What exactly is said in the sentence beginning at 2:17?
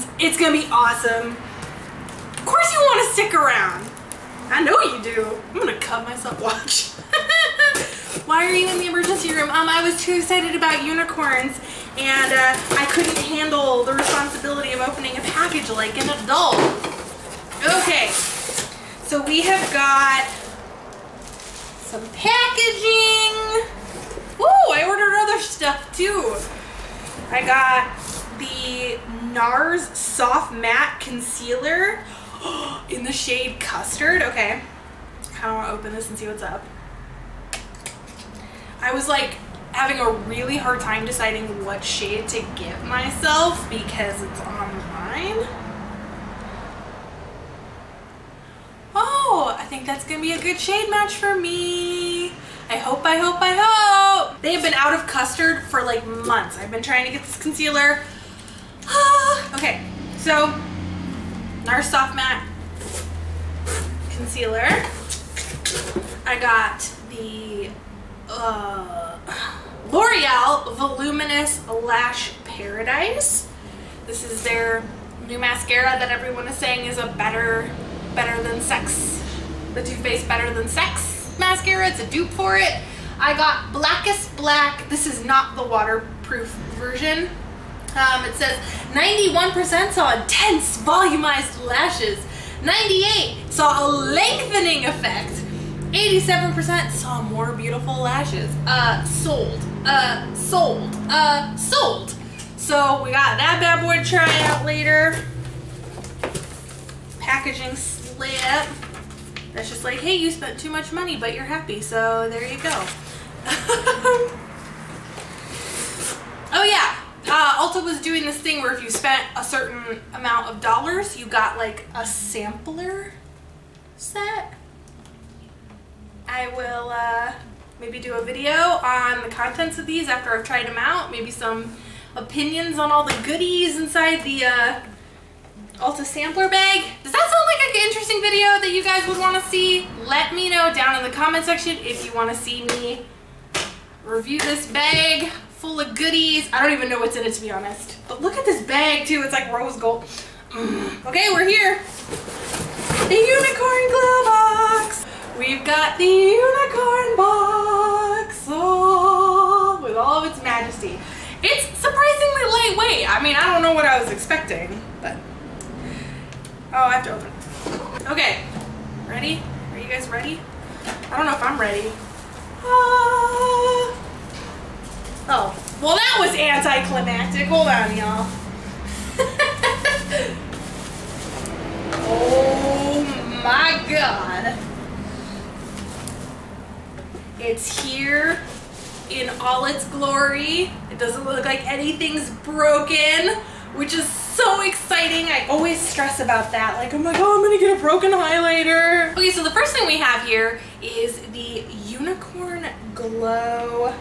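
Does that sound like an interesting video that you guys would want to see?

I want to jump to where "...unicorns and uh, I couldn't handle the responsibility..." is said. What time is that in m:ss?
0:10.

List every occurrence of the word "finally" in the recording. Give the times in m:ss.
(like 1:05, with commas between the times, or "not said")
not said.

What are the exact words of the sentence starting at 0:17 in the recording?
Okay, so we have got some packaging.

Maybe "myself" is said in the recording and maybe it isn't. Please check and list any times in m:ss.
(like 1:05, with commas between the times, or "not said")
0:06, 0:42.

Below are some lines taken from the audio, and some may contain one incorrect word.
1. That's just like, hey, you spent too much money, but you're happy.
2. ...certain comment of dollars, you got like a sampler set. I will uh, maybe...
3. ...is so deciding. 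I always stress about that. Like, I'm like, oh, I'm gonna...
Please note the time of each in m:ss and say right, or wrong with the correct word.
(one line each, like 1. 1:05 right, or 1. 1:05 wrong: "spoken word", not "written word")
1. 1:49 right
2. 1:59 wrong: "amount", not "comment"
3. 3:13 wrong: "exciting", not "deciding".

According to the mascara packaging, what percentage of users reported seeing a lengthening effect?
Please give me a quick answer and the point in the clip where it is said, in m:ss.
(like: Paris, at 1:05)
98%, at 1:32.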